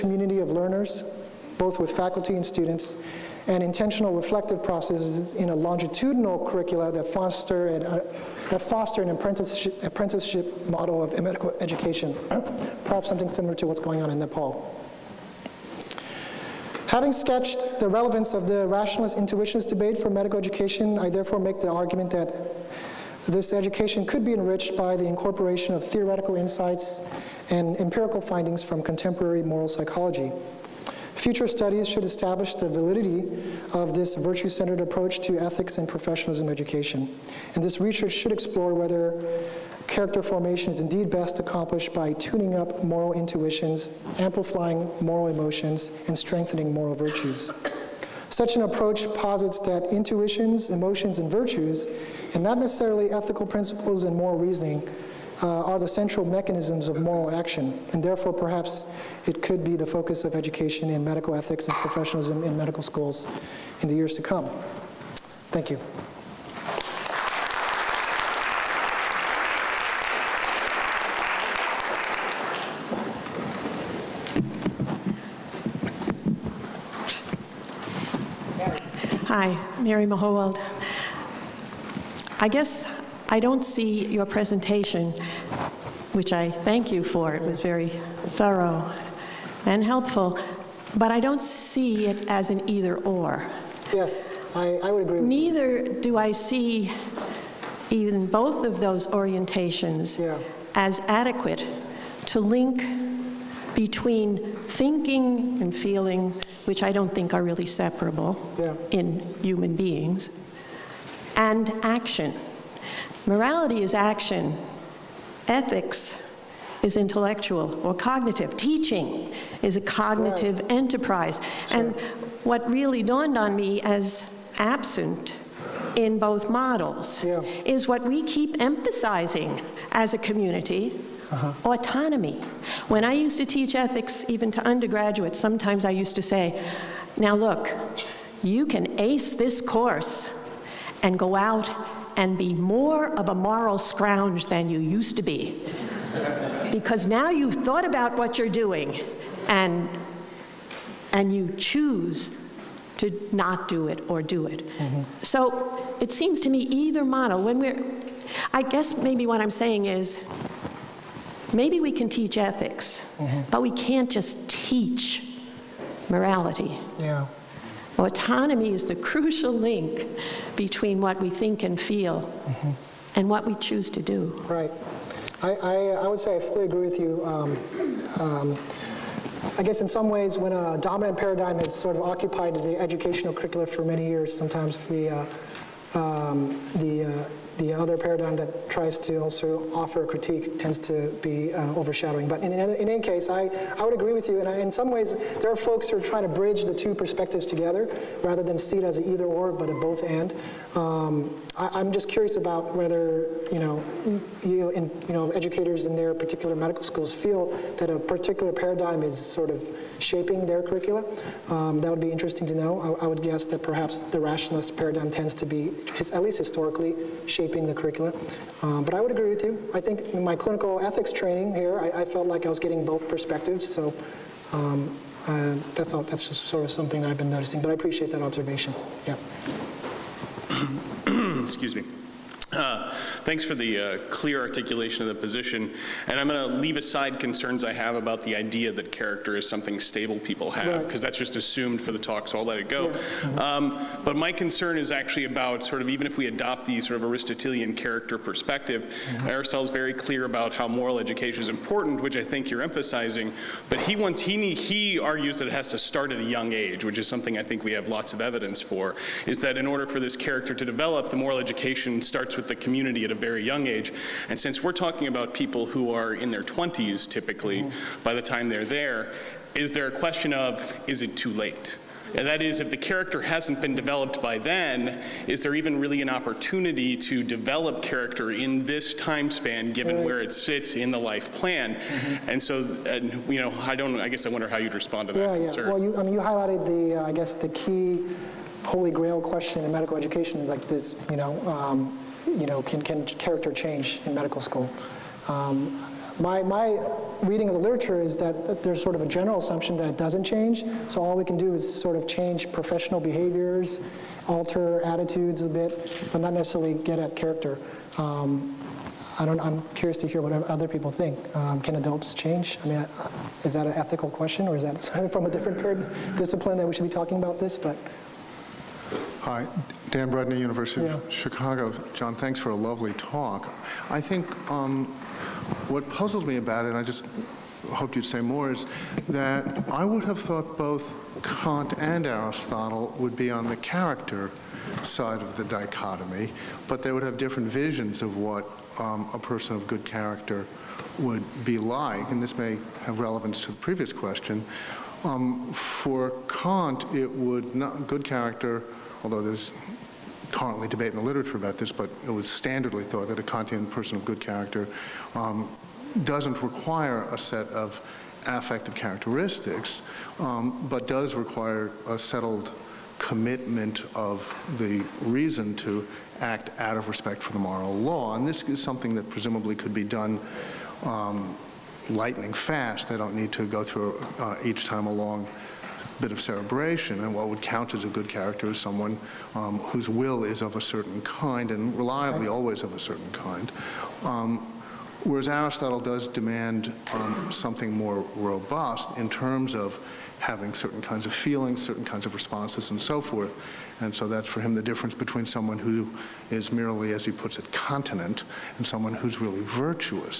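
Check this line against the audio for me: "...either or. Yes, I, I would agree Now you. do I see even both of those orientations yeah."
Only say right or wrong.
wrong.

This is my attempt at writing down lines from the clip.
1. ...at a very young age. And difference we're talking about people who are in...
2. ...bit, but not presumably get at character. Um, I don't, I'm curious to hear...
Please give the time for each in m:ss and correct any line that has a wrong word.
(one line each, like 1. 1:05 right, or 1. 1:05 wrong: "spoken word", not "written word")
1. 4:23 wrong: "since", not "difference"
2. 5:05 wrong: "necessarily", not "presumably".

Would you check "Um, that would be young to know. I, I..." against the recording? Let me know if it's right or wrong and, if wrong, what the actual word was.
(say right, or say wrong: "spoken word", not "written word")
wrong: "interesting", not "young".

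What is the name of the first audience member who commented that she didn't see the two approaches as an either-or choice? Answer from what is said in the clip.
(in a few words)
Mary Mahowald.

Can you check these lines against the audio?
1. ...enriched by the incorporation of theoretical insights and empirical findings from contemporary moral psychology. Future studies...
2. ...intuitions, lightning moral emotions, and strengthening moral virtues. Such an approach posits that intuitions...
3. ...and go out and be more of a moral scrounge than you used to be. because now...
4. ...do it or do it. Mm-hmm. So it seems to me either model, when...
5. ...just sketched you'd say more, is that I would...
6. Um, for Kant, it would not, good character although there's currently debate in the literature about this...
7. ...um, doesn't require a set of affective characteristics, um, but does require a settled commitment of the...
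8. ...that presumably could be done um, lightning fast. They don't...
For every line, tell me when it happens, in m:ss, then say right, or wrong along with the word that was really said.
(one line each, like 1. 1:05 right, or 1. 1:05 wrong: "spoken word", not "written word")
1. 0:24 right
2. 0:43 wrong: "amplifying", not "lightning"
3. 2:21 right
4. 2:33 right
5. 5:26 wrong: "hoped", not "sketched"
6. 5:45 right
7. 5:55 right
8. 6:08 right.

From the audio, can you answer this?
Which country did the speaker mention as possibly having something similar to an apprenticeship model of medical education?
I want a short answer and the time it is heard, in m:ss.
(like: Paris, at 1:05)
Nepal, at 0:14.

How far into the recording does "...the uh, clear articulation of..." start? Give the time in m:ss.
3:53.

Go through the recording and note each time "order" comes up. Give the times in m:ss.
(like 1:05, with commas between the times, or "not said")
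4:19.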